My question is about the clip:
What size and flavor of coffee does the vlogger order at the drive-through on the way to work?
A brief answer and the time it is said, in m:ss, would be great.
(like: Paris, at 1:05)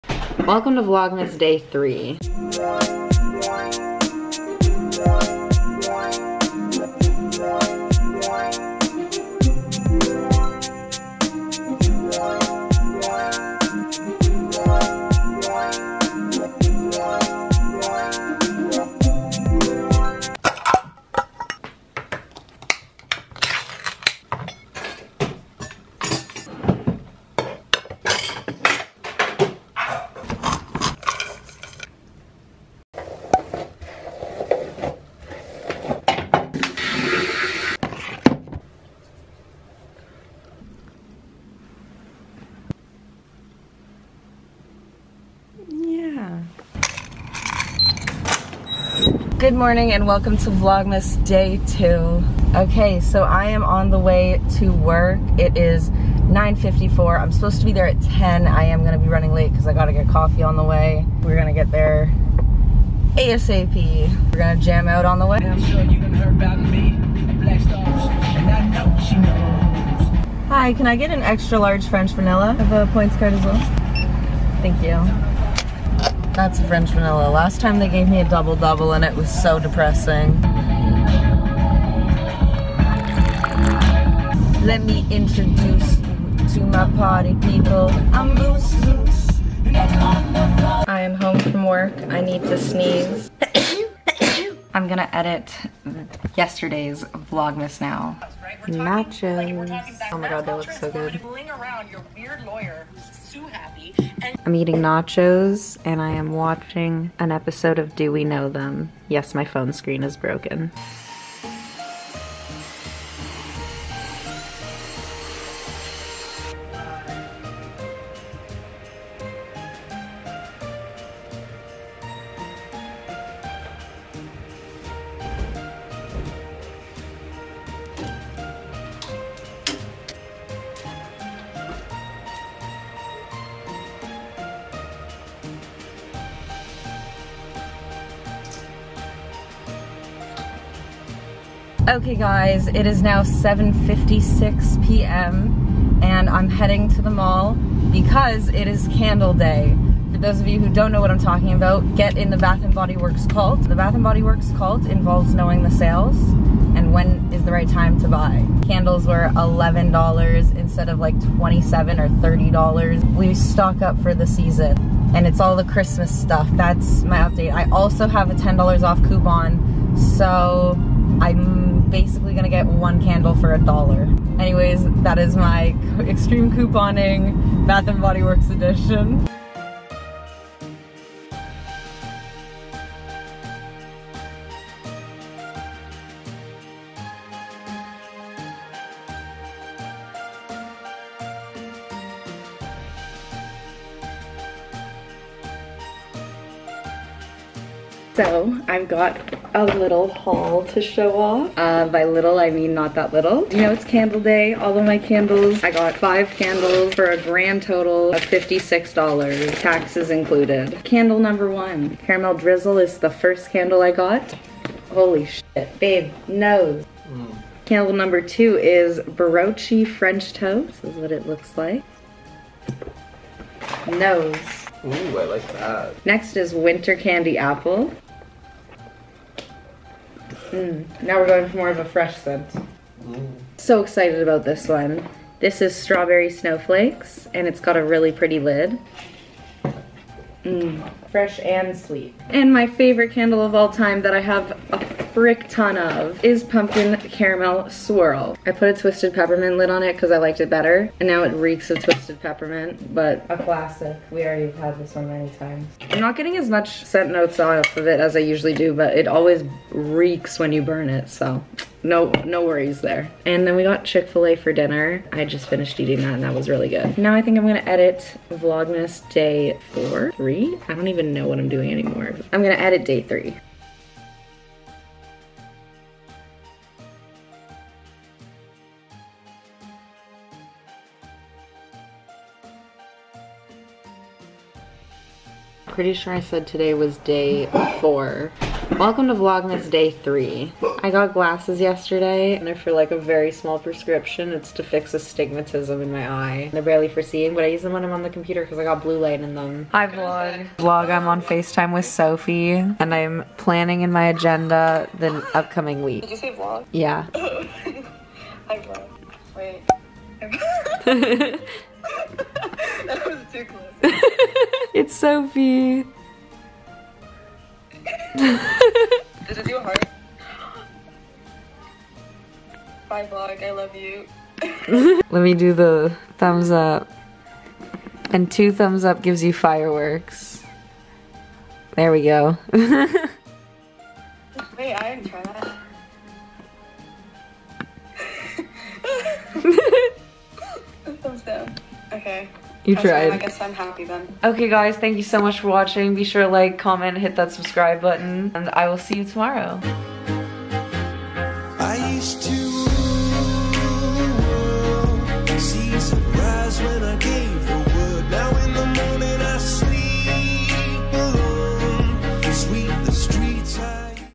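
extra large French vanilla, at 1:11.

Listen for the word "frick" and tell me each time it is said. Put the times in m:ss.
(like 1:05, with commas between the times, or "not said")
4:05.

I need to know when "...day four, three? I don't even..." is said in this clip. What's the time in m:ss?
4:29.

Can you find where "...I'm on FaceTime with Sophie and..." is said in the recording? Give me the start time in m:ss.
5:00.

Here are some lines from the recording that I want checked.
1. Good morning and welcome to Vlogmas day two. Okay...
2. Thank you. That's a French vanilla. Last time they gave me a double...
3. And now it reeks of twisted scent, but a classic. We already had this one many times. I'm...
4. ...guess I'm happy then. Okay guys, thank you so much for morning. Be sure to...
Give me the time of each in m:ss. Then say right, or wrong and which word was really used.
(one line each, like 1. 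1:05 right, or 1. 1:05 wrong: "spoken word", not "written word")
1. 0:49 right
2. 1:14 right
3. 4:10 wrong: "peppermint", not "scent"
4. 5:43 wrong: "watching", not "morning".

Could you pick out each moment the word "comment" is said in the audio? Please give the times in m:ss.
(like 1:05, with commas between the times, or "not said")
5:46.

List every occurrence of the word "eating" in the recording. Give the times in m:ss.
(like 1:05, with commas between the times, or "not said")
1:44, 4:25.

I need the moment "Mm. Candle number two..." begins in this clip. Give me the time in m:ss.
3:37.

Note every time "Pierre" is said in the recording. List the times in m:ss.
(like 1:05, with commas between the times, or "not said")
not said.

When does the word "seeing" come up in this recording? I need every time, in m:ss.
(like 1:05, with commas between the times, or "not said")
4:57.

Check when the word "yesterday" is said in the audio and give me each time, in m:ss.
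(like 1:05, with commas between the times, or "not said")
1:36, 4:51.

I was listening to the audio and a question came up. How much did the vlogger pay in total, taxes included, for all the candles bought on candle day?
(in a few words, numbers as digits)
$56.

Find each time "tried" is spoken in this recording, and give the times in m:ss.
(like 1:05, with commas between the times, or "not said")
5:42.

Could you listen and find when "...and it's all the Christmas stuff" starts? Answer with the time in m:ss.
2:45.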